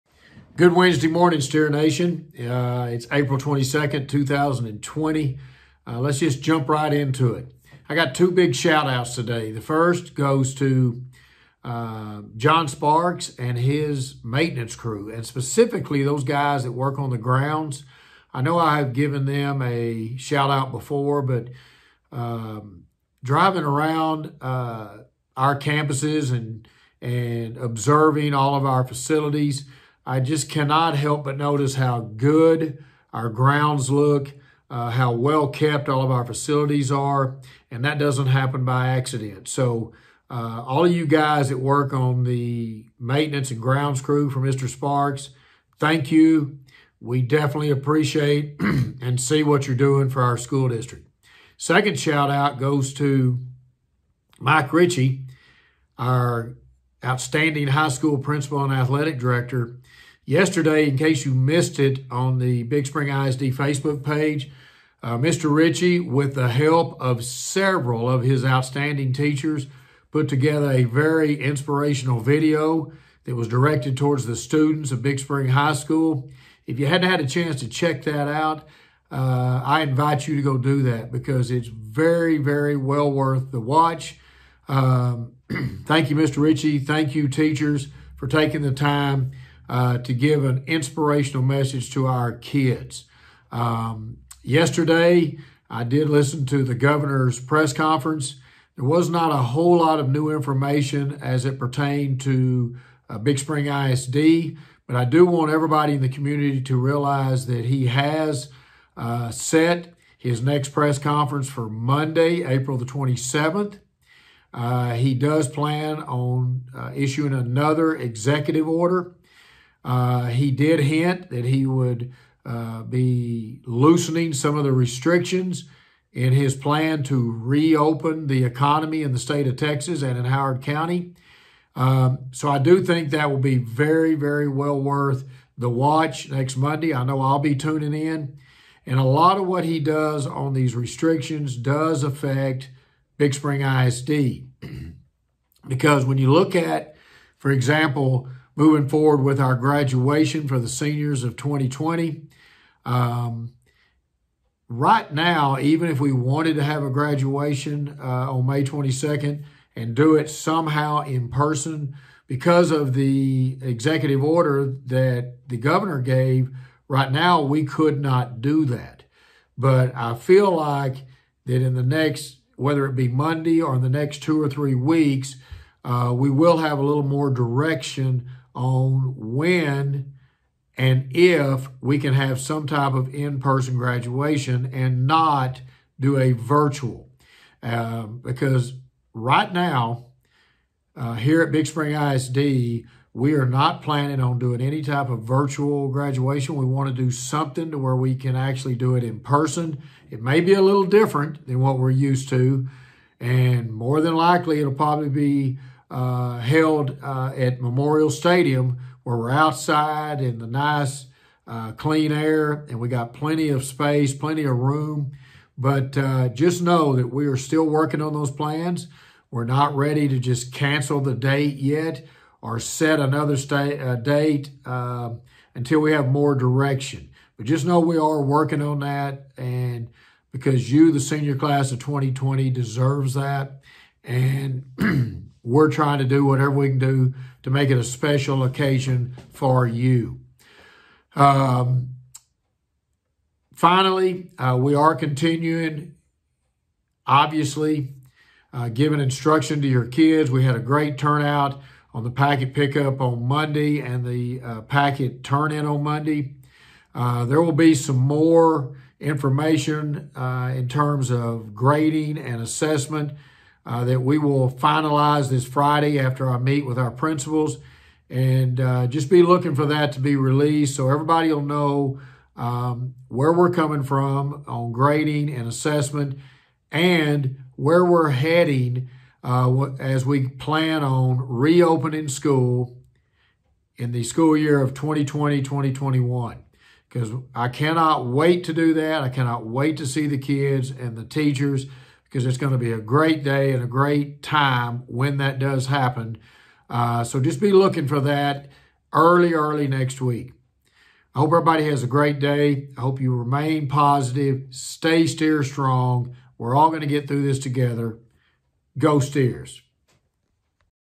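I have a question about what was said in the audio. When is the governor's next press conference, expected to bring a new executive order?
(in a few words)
April 27.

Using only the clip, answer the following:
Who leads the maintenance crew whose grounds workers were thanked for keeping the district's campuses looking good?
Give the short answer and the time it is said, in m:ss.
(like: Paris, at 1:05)
John Sparks, at 0:12.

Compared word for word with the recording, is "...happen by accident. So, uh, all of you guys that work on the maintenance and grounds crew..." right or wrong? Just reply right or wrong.
right.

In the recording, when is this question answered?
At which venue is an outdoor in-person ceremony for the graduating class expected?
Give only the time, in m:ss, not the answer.
3:27.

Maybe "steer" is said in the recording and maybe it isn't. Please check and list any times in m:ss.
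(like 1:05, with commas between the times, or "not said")
0:01, 5:05.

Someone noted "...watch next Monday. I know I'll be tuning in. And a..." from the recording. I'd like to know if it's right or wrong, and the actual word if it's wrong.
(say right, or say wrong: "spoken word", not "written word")
right.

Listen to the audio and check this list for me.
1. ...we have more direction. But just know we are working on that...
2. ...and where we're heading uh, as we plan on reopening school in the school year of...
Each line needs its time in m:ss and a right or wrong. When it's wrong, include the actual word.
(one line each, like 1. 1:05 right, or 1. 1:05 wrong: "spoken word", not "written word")
1. 3:45 right
2. 4:36 right.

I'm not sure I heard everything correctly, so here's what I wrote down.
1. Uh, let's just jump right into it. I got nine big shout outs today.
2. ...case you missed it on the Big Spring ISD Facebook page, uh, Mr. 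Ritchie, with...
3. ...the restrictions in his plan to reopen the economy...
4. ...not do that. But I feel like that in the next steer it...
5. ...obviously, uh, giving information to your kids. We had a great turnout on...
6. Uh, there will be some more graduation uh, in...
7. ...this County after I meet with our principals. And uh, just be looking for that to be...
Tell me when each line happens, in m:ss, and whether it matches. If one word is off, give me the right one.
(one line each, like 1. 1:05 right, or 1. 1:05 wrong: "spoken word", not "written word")
1. 0:05 wrong: "two", not "nine"
2. 1:00 right
3. 2:04 right
4. 2:48 wrong: "whether", not "steer"
5. 4:07 wrong: "instruction", not "information"
6. 4:16 wrong: "information", not "graduation"
7. 4:25 wrong: "Friday", not "County".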